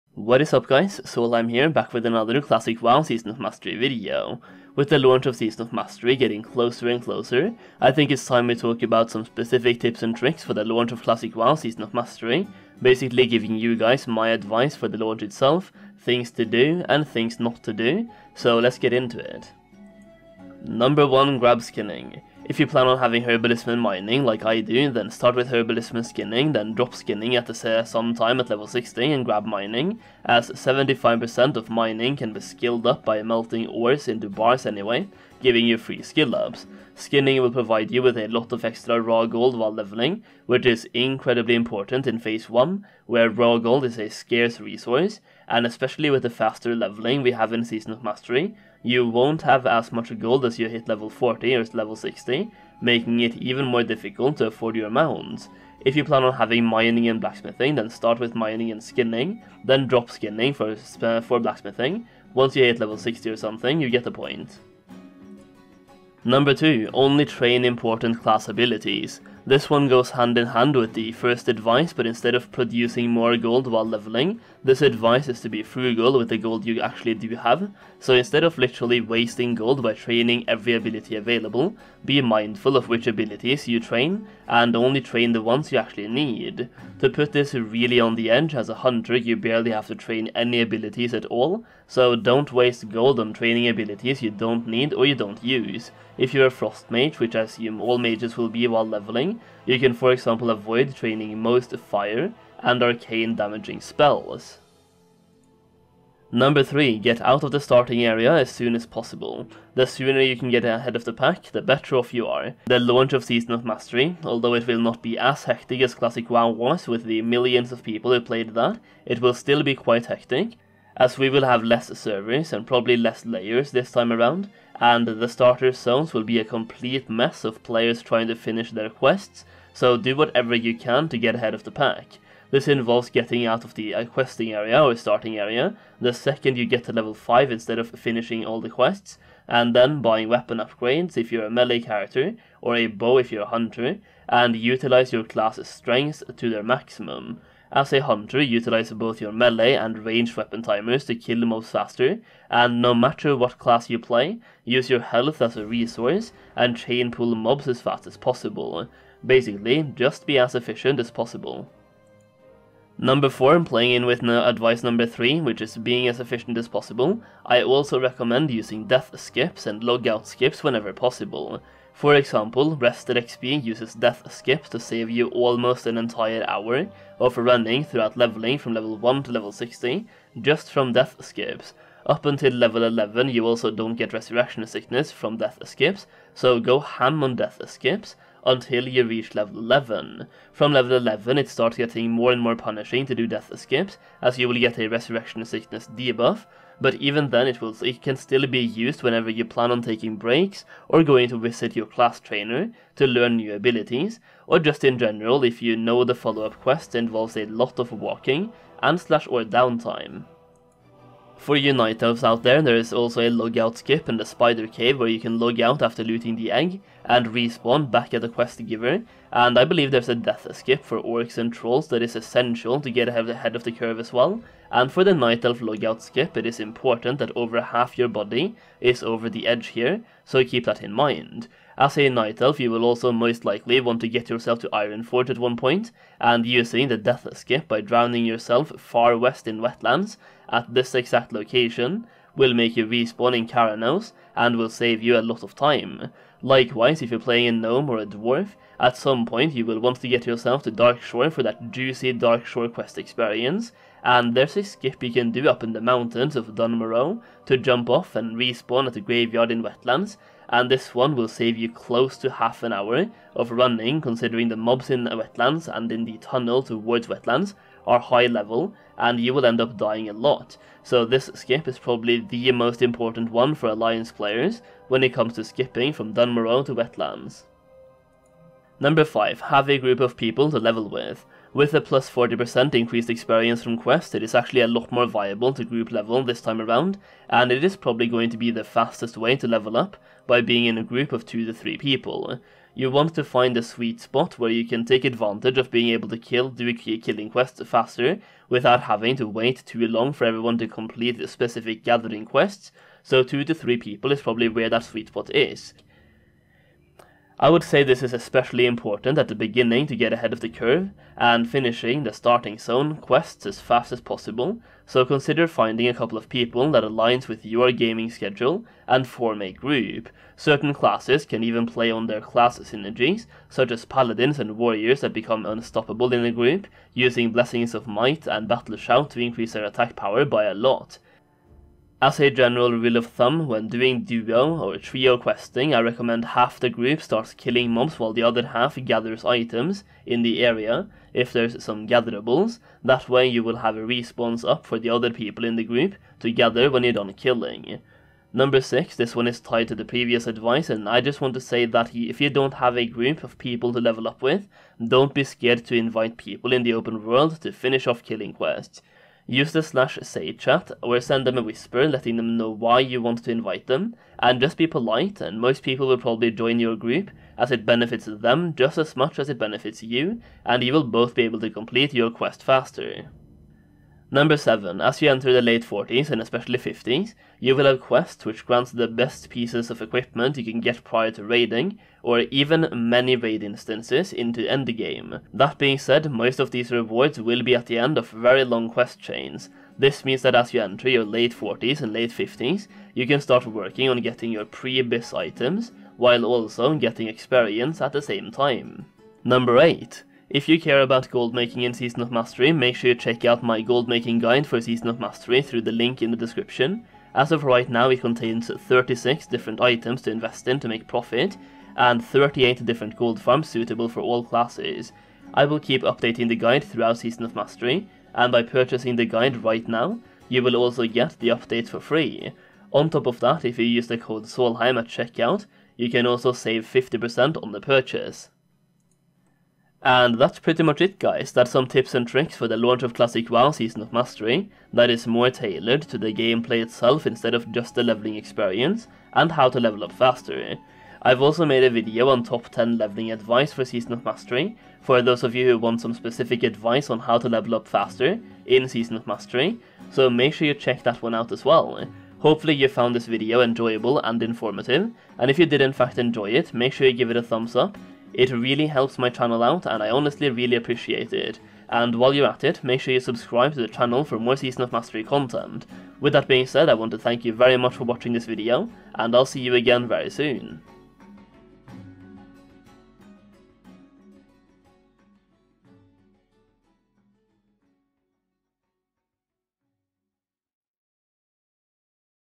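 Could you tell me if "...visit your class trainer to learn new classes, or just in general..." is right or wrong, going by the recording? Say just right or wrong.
wrong.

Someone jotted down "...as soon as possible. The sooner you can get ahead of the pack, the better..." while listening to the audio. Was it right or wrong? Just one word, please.
right.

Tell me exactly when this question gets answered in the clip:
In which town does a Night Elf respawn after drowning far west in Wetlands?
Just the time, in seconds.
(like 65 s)
243 s.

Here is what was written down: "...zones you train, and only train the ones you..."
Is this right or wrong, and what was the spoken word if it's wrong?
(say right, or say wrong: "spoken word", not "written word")
wrong: "abilities", not "zones".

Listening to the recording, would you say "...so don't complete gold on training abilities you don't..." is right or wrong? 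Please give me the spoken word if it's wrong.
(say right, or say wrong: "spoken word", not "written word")
wrong: "waste", not "complete".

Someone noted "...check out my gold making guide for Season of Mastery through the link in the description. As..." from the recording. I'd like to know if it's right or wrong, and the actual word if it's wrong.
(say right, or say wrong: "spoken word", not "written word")
right.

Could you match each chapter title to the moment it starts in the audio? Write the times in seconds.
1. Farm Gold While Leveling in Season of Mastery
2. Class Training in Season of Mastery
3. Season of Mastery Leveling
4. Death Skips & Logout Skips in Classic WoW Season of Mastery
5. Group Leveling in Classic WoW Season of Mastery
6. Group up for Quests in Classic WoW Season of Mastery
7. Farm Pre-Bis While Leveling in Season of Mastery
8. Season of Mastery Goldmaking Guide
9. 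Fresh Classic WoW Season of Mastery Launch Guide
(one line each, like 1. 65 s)
1. 20 s
2. 68 s
3. 106 s
4. 162 s
5. 278 s
6. 348 s
7. 373 s
8. 399 s
9. 428 s.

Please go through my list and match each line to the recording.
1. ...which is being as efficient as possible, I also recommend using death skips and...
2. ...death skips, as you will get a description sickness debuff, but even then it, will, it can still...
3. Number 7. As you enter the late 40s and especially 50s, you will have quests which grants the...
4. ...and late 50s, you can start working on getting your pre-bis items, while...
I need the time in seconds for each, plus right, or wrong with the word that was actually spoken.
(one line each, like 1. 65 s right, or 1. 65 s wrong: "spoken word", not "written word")
1. 165 s right
2. 193 s wrong: "resurrection", not "description"
3. 374 s right
4. 391 s right.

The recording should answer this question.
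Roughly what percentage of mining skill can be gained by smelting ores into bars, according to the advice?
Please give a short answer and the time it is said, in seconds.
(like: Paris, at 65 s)
75%, at 30 s.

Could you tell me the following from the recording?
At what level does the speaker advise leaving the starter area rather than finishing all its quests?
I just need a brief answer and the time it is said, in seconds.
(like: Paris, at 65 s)
Level 5, at 136 s.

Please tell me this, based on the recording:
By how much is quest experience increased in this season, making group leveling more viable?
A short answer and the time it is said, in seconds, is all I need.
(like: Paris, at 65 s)
40%, at 281 s.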